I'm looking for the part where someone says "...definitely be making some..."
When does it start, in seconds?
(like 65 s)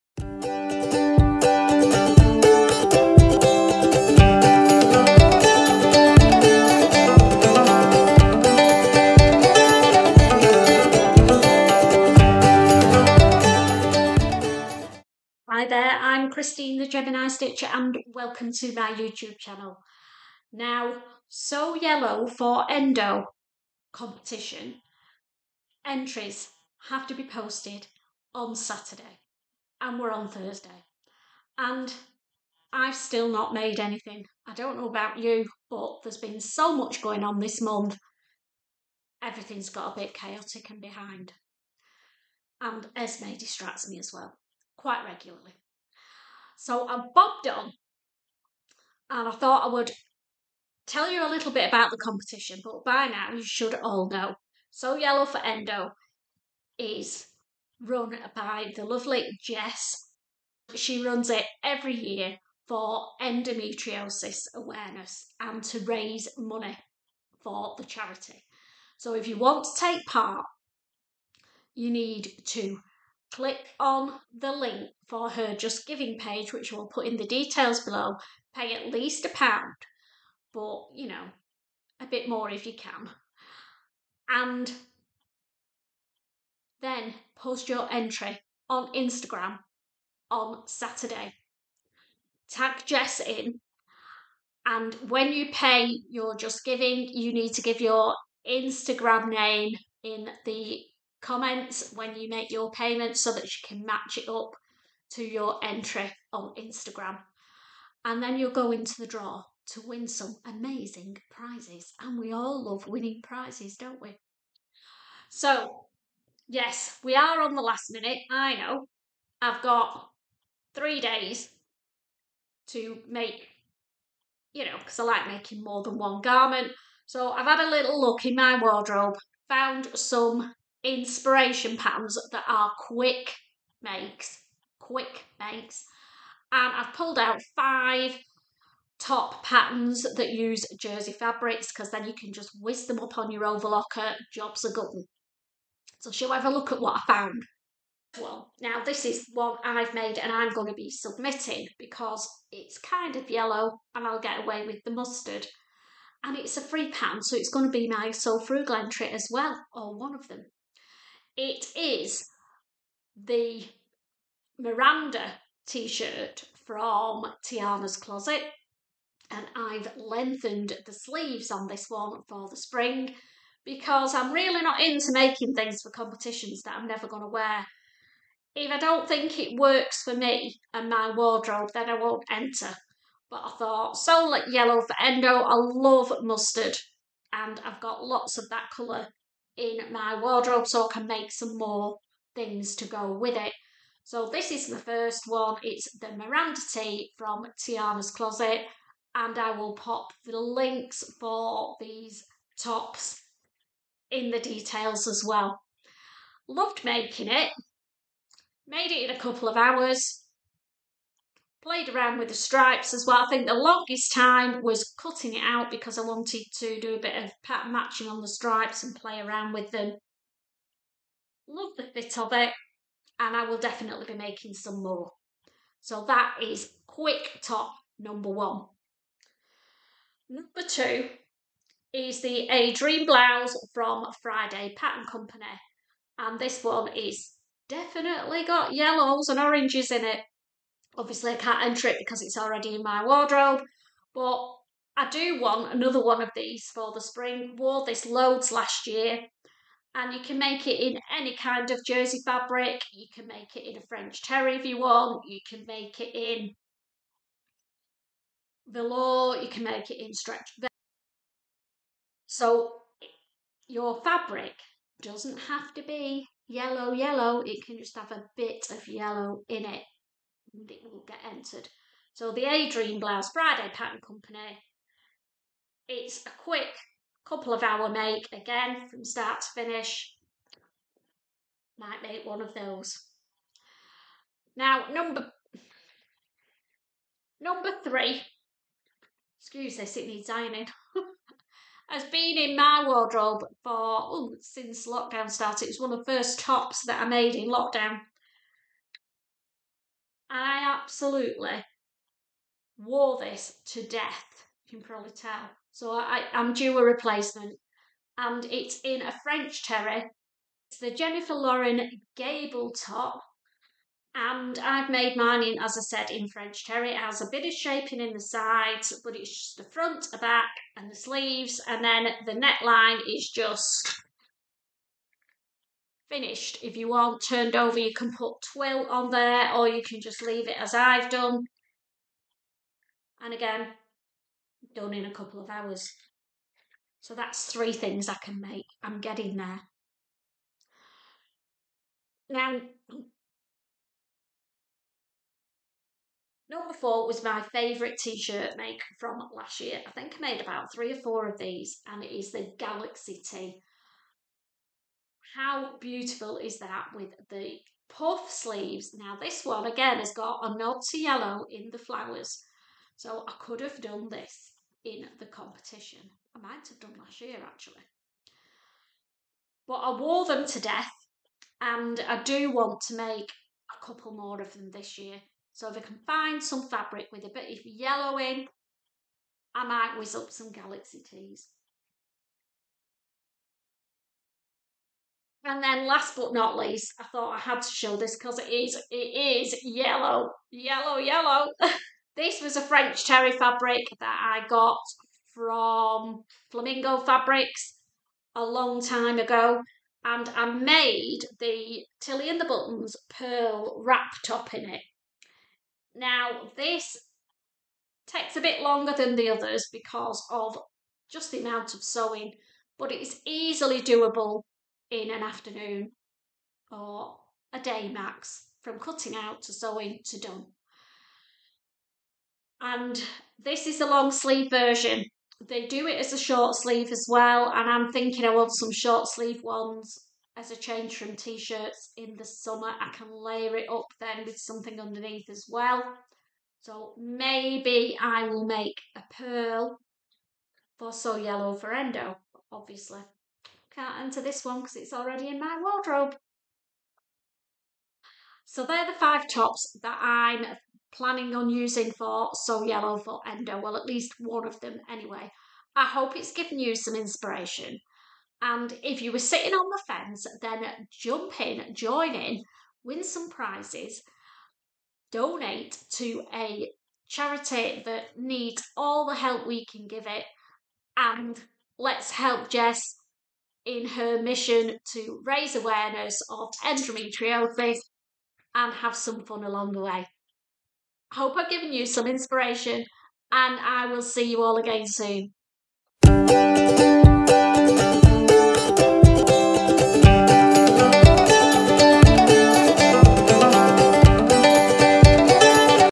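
223 s.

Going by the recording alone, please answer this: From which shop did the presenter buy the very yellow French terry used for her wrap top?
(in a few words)
Flamingo Fabrics.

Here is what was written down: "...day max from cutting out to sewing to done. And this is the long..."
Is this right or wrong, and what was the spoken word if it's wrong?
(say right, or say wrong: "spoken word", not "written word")
right.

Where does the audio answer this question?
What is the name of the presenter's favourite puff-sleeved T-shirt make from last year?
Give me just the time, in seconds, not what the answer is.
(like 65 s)
352 s.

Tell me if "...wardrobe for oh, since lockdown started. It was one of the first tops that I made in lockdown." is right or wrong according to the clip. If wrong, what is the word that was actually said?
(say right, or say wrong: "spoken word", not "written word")
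right.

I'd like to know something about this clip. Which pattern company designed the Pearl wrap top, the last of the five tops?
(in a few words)
Tilly and the Buttons.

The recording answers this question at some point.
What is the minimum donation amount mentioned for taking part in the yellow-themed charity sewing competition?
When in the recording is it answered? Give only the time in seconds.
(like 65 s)
79 s.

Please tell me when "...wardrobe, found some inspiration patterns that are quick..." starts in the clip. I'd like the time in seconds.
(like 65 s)
128 s.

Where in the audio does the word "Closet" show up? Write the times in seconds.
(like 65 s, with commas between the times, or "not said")
167 s, 198 s.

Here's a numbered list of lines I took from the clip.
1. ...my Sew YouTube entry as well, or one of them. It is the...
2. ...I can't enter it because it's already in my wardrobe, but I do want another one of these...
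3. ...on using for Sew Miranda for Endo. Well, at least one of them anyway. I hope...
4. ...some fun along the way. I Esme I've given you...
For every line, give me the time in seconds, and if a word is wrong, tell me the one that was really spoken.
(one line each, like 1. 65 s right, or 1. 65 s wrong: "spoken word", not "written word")
1. 157 s wrong: "Frugal", not "YouTube"
2. 241 s right
3. 451 s wrong: "Yellow", not "Miranda"
4. 478 s wrong: "Hope", not "Esme".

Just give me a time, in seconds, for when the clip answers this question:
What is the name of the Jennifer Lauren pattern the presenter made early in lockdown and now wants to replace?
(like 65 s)
312 s.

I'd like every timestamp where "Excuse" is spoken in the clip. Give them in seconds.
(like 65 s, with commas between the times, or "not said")
289 s.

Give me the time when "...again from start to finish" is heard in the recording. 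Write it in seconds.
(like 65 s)
278 s.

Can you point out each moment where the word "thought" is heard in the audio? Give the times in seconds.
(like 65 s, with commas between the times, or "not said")
49 s, 183 s, 387 s.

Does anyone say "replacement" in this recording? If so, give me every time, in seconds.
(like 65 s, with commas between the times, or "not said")
306 s.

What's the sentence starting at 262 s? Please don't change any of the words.
So your fabric doesn't have to be yellow, yellow.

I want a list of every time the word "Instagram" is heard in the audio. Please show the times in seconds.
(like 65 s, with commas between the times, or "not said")
88 s, 98 s, 106 s.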